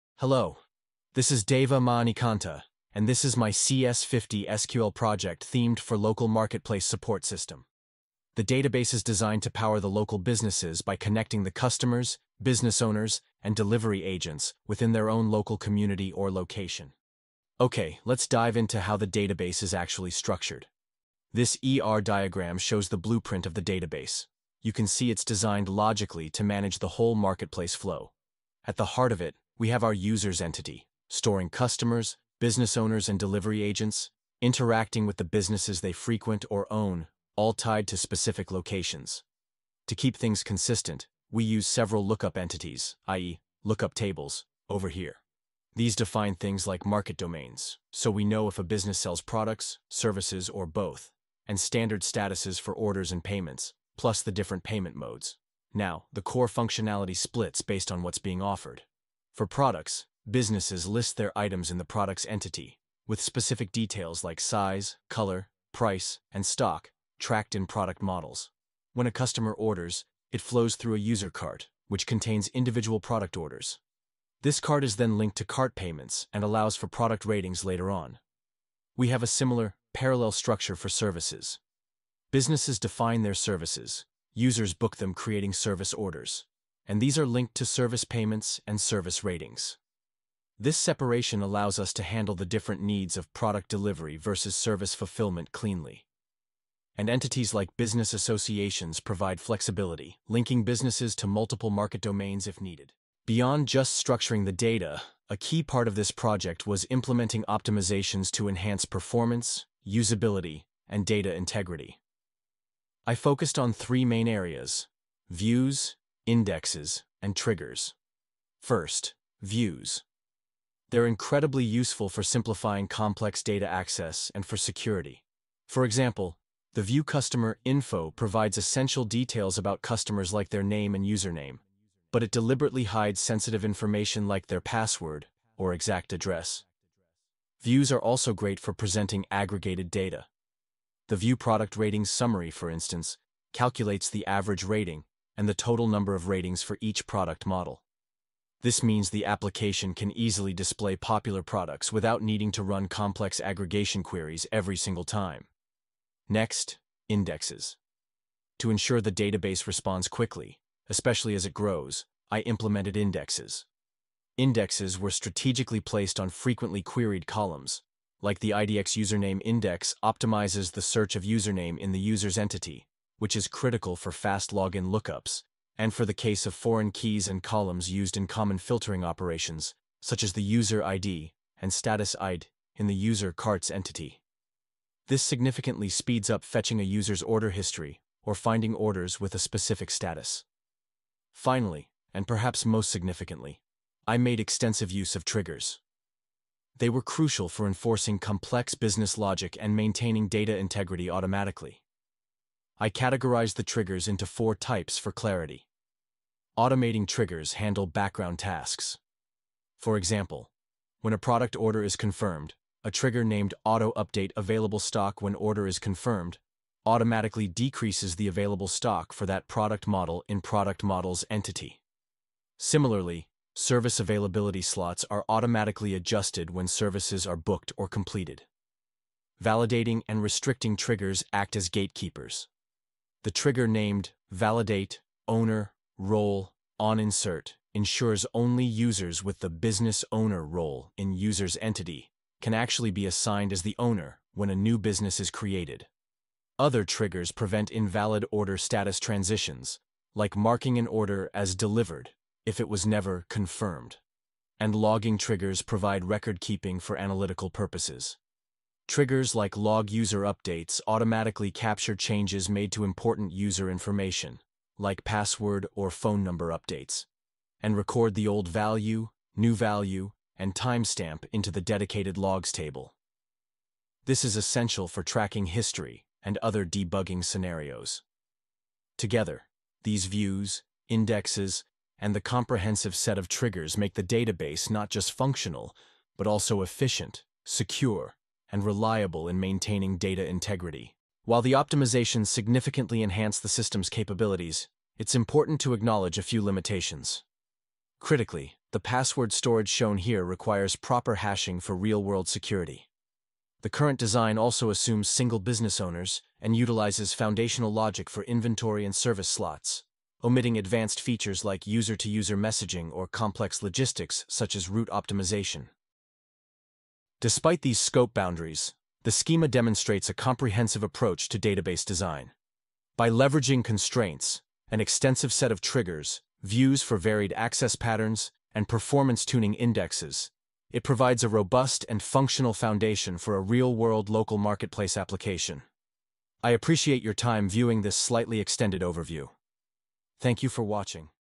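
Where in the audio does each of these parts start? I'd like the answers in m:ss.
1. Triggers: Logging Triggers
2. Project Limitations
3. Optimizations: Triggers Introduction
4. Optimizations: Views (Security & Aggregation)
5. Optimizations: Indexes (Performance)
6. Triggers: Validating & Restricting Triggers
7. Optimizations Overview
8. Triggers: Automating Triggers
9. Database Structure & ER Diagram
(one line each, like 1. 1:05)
1. 4:14
2. 4:51
3. 3:11
4. 1:58
5. 2:36
6. 3:49
7. 1:43
8. 3:26
9. 0:17.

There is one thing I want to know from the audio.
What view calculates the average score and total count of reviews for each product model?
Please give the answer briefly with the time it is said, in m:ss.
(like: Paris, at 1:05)
View Product Ratings Summary, at 2:21.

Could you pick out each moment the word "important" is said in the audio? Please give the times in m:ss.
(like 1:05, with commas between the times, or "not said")
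4:22, 4:55.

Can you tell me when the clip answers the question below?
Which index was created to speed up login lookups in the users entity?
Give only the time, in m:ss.
2:48.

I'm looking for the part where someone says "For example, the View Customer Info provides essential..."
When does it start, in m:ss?
2:05.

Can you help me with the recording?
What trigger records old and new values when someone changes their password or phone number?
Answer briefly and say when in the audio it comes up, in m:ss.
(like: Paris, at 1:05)
log user updates, at 4:19.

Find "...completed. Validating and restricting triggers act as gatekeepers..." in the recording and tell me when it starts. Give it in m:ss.
3:47.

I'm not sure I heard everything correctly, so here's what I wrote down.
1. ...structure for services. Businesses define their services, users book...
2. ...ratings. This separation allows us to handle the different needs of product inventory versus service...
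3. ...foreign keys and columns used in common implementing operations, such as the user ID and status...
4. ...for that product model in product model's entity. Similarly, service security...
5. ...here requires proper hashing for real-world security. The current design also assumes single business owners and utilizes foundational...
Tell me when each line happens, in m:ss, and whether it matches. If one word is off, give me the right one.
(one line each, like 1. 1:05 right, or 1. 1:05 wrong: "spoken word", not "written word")
1. 1:20 right
2. 1:29 wrong: "delivery", not "inventory"
3. 2:56 wrong: "filtering", not "implementing"
4. 3:39 wrong: "availability", not "security"
5. 4:59 right.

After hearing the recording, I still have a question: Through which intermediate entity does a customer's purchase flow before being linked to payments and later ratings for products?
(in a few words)
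user cart.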